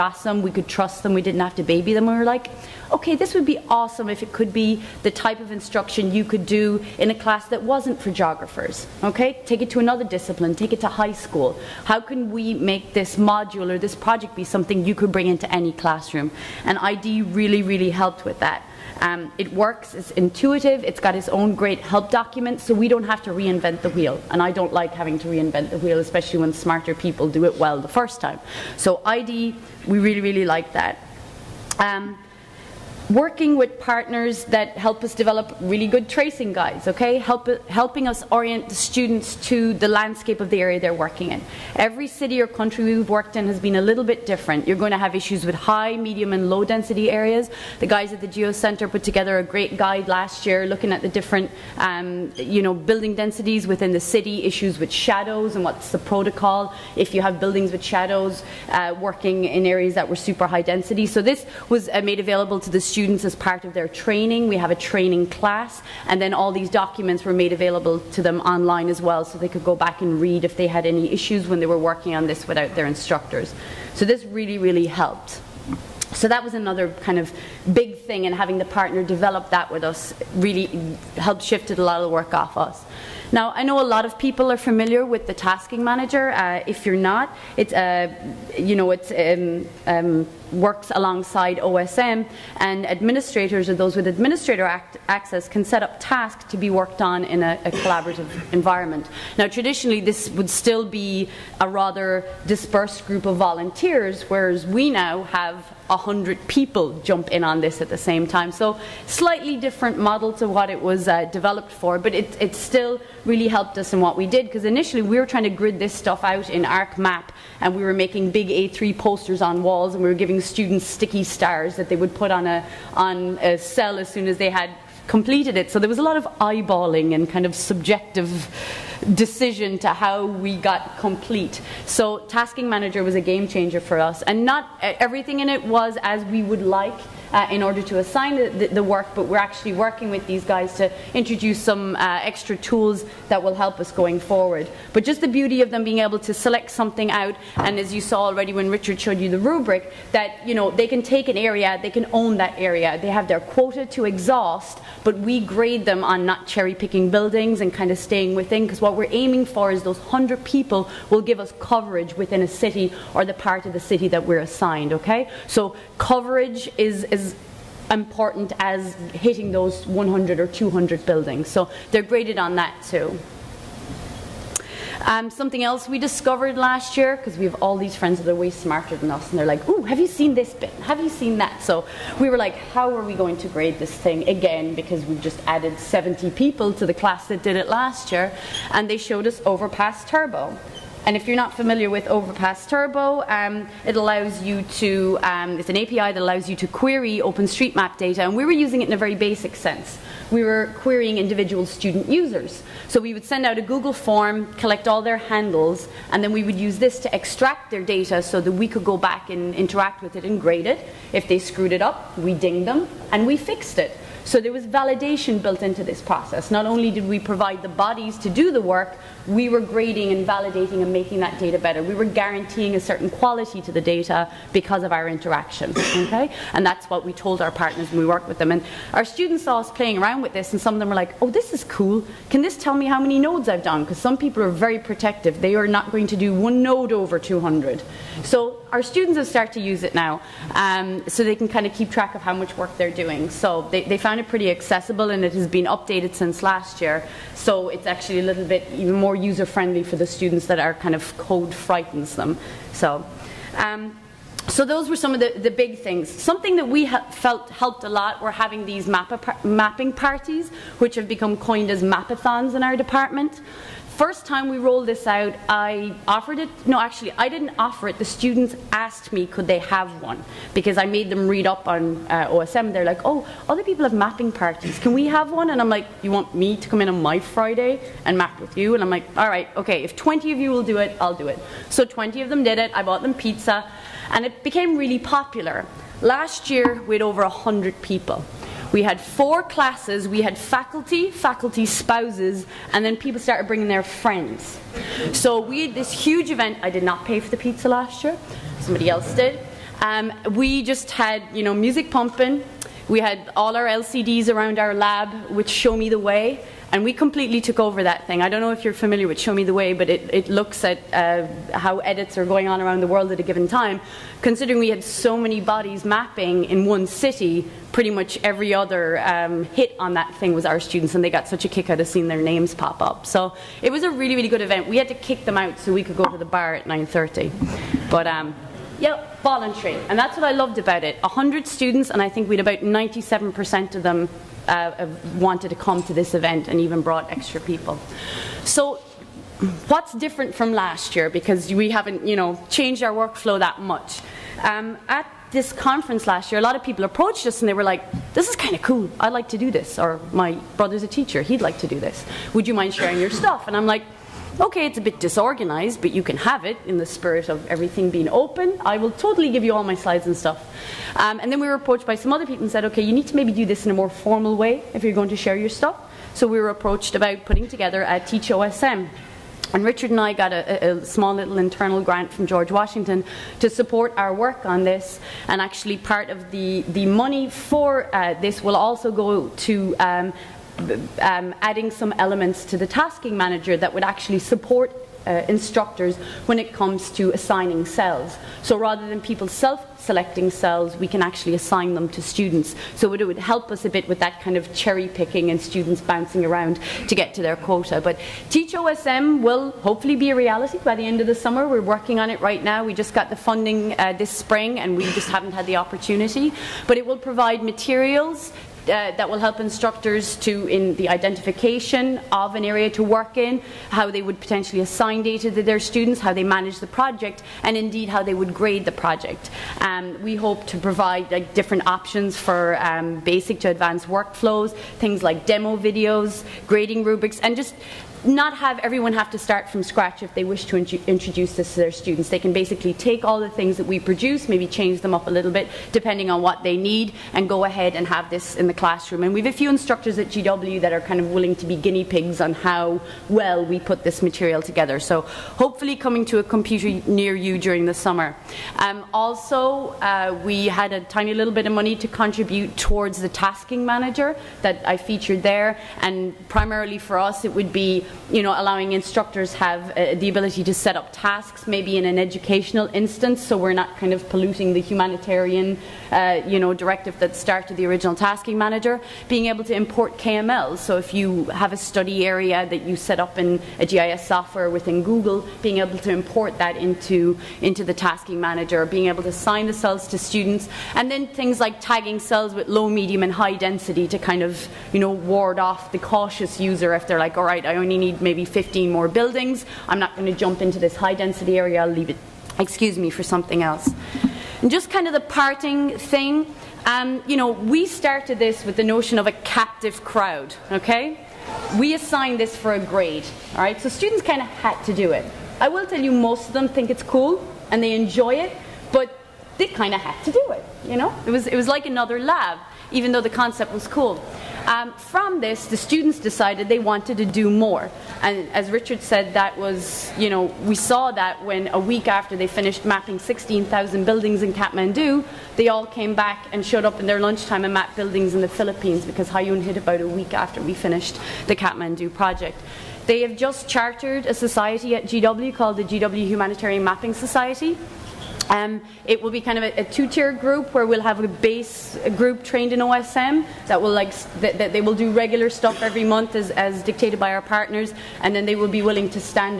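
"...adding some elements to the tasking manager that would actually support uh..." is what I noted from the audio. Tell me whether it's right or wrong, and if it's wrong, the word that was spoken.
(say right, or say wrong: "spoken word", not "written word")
right.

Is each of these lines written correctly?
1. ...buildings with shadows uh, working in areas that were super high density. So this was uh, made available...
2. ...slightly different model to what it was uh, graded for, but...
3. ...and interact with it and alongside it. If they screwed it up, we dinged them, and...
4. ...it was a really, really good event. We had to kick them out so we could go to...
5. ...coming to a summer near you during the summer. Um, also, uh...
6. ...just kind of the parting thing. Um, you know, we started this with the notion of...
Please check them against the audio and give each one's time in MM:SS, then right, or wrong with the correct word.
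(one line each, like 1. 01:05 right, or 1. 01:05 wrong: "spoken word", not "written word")
1. 00:57 right
2. 01:49 wrong: "developed", not "graded"
3. 03:29 wrong: "grade", not "alongside"
4. 05:23 right
5. 07:25 wrong: "computer", not "summer"
6. 08:14 right.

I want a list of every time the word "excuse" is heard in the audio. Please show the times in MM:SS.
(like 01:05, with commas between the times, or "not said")
08:12.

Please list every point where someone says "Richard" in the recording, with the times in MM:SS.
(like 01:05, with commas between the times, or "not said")
02:28, 06:09, 08:38.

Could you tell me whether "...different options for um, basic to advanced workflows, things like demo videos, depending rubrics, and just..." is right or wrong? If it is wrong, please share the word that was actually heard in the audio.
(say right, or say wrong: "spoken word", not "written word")
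wrong: "grading", not "depending".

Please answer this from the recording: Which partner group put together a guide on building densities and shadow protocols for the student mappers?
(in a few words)
the Geo Center.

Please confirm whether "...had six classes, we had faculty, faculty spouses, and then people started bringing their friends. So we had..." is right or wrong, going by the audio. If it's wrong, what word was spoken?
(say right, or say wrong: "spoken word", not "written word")
wrong: "four", not "six".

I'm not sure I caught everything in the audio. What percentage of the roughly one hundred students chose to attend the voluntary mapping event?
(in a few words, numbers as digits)
97%.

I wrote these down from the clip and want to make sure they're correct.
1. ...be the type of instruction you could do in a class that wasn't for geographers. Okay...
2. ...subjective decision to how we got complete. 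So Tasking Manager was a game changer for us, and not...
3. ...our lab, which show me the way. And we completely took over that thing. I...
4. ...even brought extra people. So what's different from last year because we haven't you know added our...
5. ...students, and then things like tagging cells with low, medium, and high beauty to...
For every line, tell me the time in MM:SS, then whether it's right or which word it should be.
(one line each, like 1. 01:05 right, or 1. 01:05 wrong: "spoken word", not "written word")
1. 00:04 right
2. 02:07 right
3. 05:04 right
4. 05:36 wrong: "changed", not "added"
5. 07:59 wrong: "density", not "beauty".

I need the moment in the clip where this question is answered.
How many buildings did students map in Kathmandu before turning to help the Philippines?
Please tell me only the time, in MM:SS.
08:42.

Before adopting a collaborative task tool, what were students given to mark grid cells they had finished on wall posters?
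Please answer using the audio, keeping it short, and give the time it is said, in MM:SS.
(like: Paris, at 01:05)
sticky stars, at 02:00.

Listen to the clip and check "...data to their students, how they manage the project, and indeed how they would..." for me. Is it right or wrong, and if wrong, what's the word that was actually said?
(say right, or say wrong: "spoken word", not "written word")
right.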